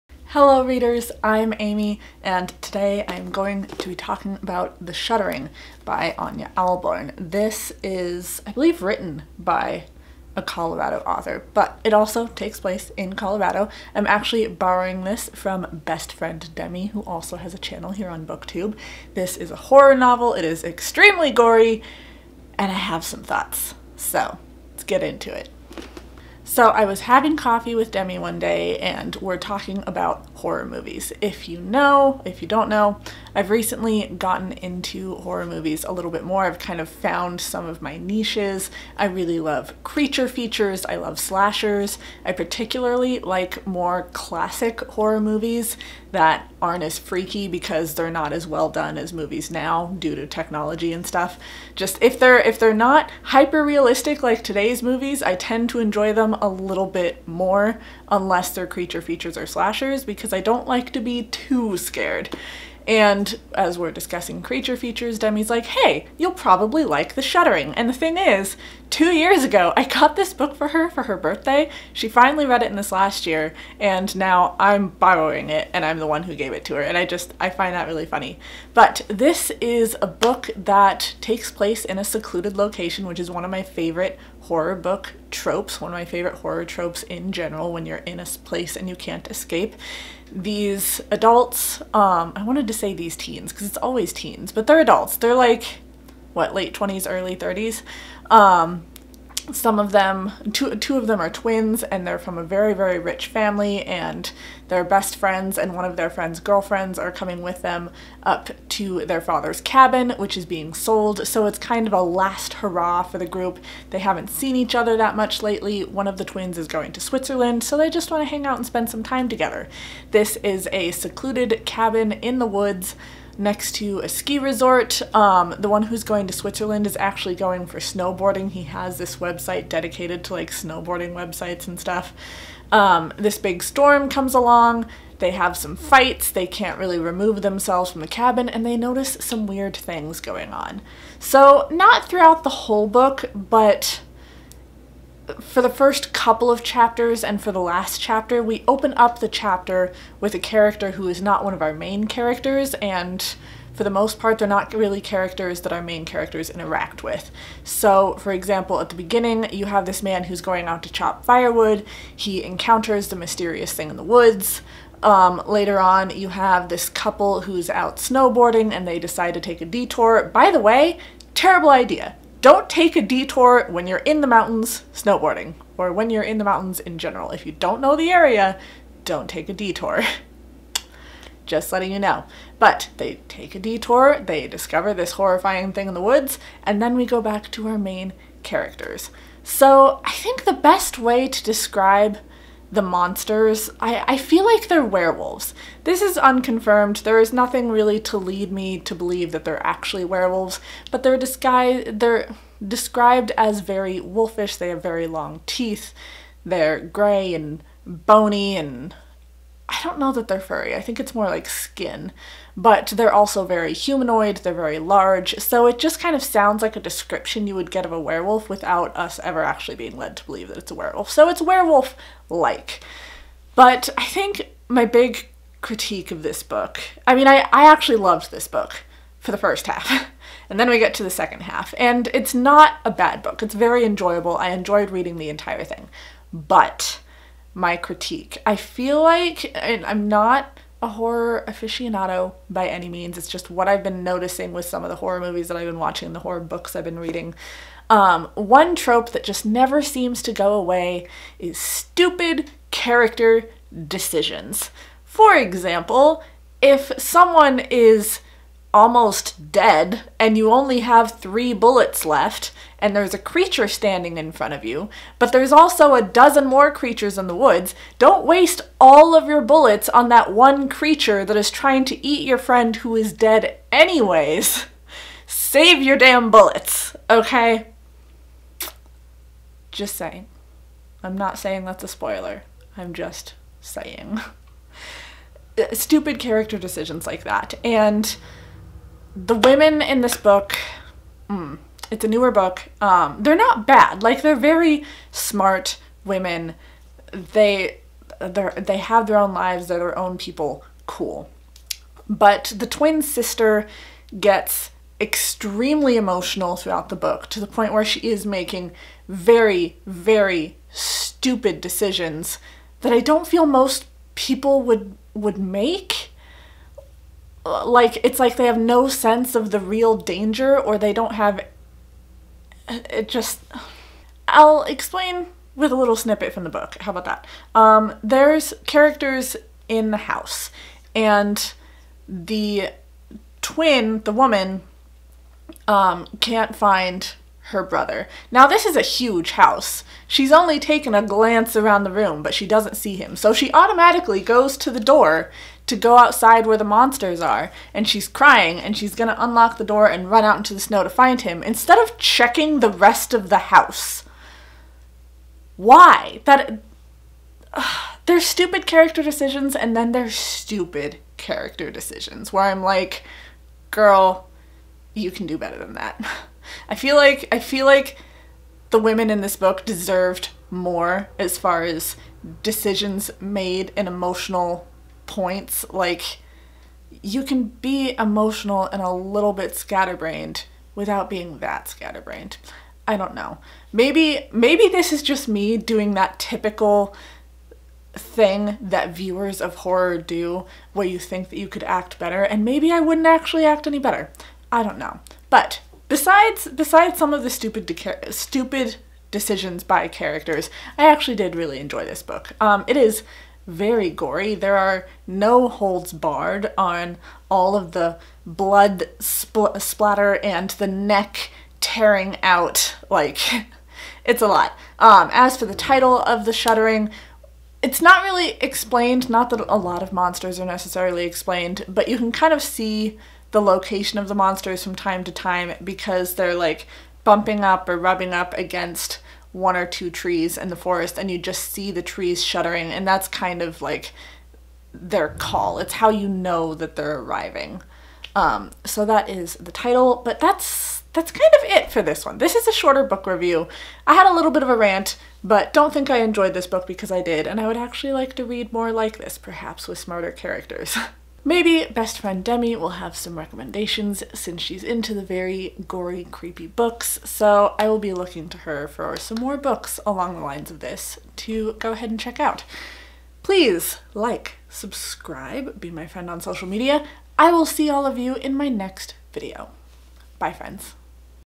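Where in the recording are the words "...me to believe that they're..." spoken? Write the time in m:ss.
3:18.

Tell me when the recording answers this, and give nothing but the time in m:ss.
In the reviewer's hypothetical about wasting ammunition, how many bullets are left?
4:21.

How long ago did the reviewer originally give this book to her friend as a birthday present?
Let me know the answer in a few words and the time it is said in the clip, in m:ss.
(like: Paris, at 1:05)
2 years, at 1:08.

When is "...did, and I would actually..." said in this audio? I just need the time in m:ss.
7:27.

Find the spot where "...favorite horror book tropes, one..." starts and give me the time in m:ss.
1:23.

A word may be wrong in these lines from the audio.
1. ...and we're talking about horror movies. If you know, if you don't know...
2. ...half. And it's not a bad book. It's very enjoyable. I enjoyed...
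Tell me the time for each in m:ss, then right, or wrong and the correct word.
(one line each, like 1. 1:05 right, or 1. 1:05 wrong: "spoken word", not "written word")
1. 0:28 right
2. 3:51 right.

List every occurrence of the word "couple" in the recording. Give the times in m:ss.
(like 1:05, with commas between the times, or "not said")
2:26, 2:46.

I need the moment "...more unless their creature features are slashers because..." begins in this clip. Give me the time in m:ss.
0:57.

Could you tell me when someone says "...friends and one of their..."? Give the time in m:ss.
1:45.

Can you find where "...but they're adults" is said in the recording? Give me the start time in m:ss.
1:34.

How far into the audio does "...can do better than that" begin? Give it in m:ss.
6:05.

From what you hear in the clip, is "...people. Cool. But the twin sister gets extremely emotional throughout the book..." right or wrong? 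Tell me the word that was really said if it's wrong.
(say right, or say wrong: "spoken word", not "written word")
right.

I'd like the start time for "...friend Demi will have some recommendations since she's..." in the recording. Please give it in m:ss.
7:31.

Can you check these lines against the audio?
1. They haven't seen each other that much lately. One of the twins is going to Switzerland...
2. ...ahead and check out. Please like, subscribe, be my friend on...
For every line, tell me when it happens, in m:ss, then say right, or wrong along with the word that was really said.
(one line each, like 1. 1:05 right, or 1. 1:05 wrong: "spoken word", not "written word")
1. 1:53 right
2. 7:41 right.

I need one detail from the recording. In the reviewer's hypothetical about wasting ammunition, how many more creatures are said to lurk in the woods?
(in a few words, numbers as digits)
A dozen.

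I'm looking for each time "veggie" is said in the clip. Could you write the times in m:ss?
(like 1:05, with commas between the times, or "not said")
not said.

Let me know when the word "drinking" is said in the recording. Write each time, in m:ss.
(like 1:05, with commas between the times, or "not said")
not said.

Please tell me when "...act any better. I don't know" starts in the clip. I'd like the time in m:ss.
6:33.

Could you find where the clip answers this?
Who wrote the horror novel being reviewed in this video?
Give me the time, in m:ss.
0:06.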